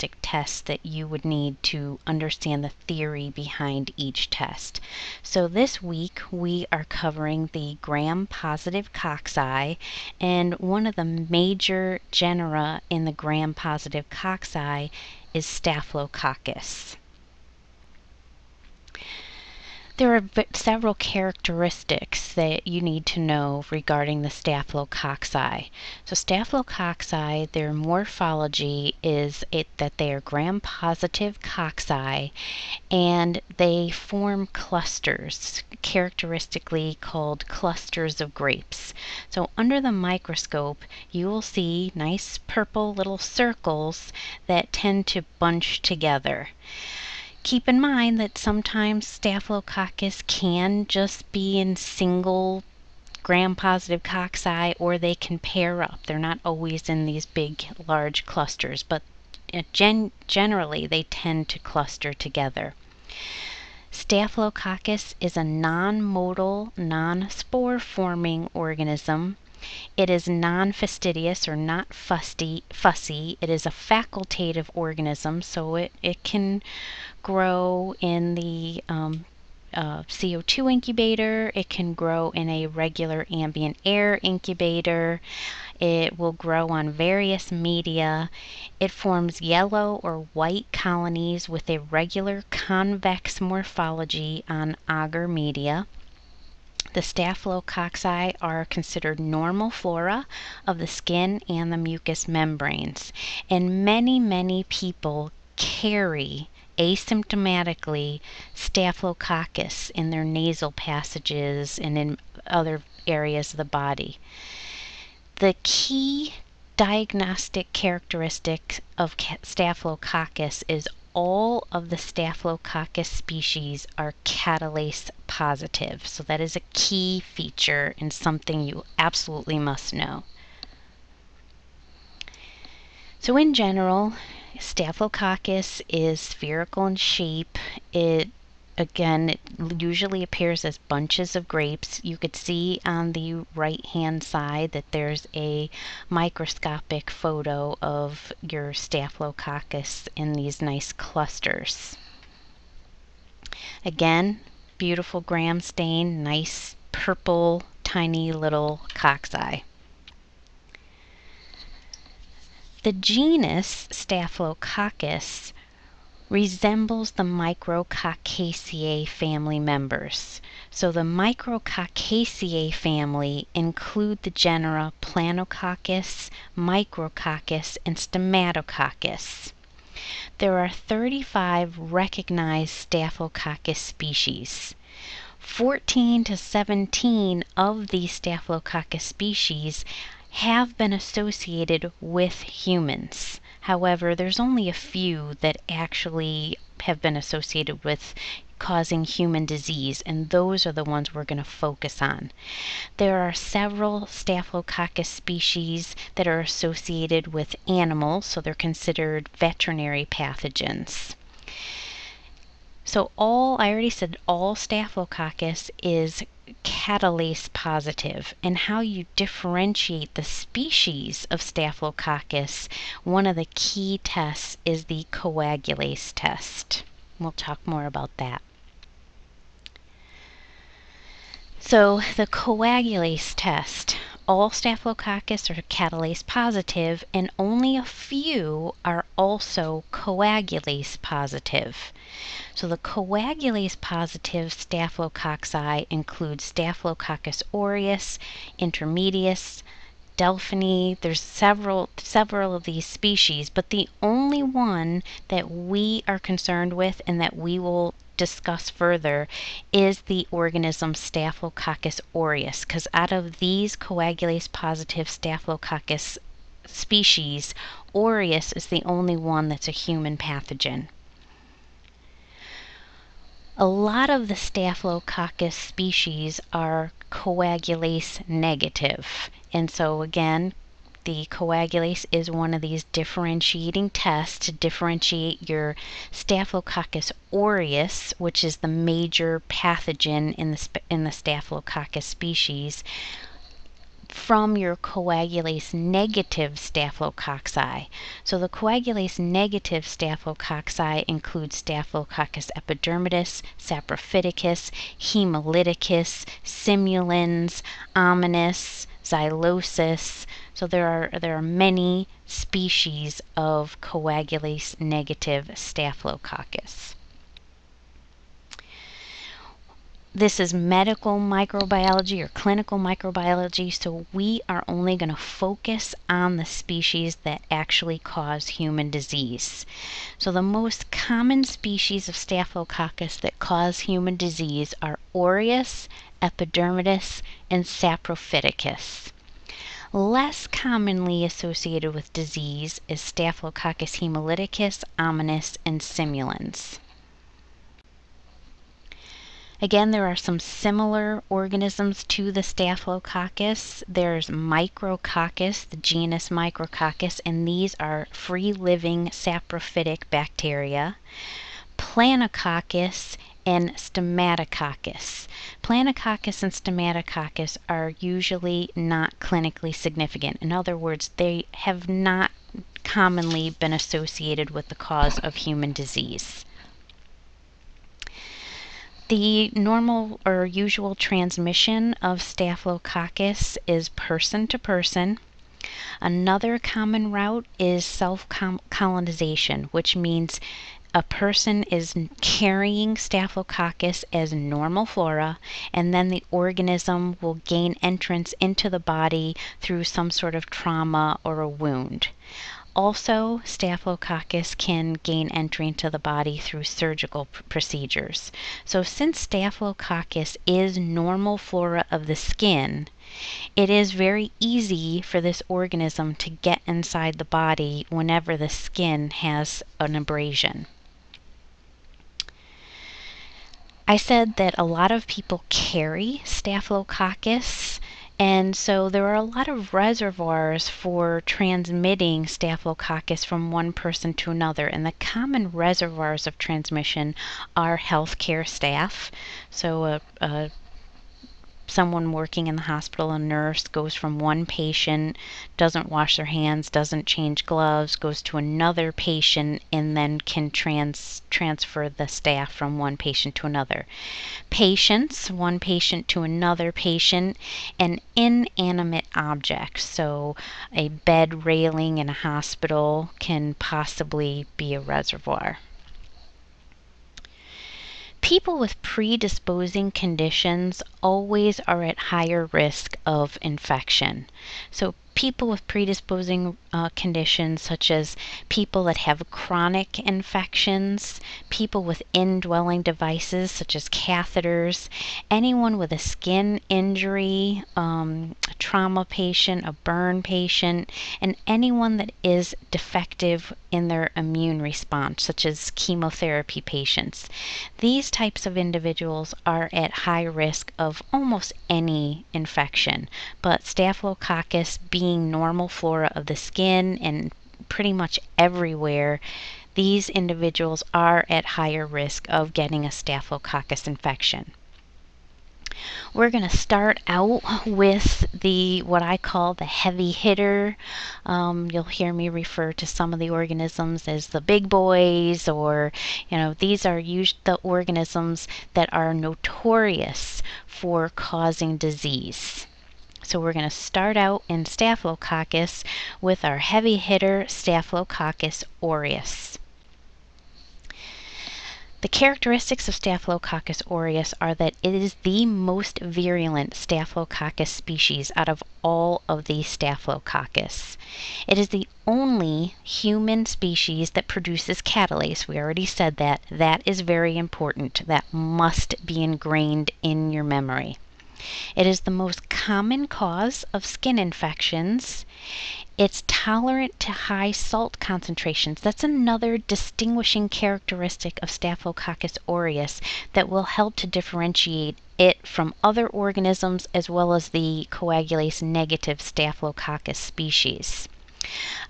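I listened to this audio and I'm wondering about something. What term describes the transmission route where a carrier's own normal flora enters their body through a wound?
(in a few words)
self colonization.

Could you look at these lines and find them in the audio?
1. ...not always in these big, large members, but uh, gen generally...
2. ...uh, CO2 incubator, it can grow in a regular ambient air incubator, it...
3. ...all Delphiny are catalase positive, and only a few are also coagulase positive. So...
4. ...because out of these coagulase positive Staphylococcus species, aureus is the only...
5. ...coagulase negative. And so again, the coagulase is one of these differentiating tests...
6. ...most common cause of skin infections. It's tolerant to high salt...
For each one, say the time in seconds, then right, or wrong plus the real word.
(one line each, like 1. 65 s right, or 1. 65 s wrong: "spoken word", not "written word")
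1. 56 s wrong: "clusters", not "members"
2. 79 s right
3. 234 s wrong: "Staphylococcus", not "Delphiny"
4. 262 s right
5. 277 s right
6. 562 s right.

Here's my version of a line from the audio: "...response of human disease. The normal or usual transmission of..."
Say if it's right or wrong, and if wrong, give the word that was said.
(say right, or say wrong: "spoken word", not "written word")
wrong: "cause", not "response".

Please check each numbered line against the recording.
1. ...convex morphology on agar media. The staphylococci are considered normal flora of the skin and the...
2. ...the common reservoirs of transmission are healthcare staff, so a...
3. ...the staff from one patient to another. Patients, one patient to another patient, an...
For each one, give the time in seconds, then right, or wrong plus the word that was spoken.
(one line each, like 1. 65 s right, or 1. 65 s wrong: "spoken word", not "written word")
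1. 92 s right
2. 434 s right
3. 451 s right.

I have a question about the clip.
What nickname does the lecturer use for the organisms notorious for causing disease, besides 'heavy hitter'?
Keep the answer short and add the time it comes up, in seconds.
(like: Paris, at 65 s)
the big boys, at 524 s.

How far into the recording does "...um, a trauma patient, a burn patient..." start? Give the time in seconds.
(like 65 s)
487 s.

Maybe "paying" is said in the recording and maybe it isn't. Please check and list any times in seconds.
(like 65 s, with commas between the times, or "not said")
not said.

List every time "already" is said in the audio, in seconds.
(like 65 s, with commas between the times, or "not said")
213 s, 555 s.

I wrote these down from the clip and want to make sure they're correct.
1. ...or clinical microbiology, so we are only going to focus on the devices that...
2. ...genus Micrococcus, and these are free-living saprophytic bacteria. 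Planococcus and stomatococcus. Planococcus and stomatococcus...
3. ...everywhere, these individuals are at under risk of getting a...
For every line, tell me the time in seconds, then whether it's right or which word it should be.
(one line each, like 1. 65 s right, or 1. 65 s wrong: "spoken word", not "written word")
1. 322 s wrong: "species", not "devices"
2. 355 s right
3. 508 s wrong: "higher", not "under".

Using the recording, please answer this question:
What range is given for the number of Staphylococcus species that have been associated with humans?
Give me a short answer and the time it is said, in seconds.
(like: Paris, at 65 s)
14 to 17, at 185 s.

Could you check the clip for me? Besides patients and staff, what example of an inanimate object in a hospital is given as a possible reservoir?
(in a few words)
bed railing.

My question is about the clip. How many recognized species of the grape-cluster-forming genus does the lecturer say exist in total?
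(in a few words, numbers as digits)
35.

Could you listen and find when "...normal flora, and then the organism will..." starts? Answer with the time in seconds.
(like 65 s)
394 s.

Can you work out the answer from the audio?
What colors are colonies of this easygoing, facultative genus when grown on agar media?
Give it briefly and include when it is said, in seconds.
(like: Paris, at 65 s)
yellow or white, at 89 s.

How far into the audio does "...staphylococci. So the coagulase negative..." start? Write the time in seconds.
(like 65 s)
296 s.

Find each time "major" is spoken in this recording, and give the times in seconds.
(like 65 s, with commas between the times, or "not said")
11 s, 288 s.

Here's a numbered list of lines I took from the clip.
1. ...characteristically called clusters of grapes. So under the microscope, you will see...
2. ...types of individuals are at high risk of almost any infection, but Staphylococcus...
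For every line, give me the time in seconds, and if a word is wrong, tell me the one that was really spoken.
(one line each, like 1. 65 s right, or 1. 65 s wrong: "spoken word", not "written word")
1. 35 s right
2. 498 s right.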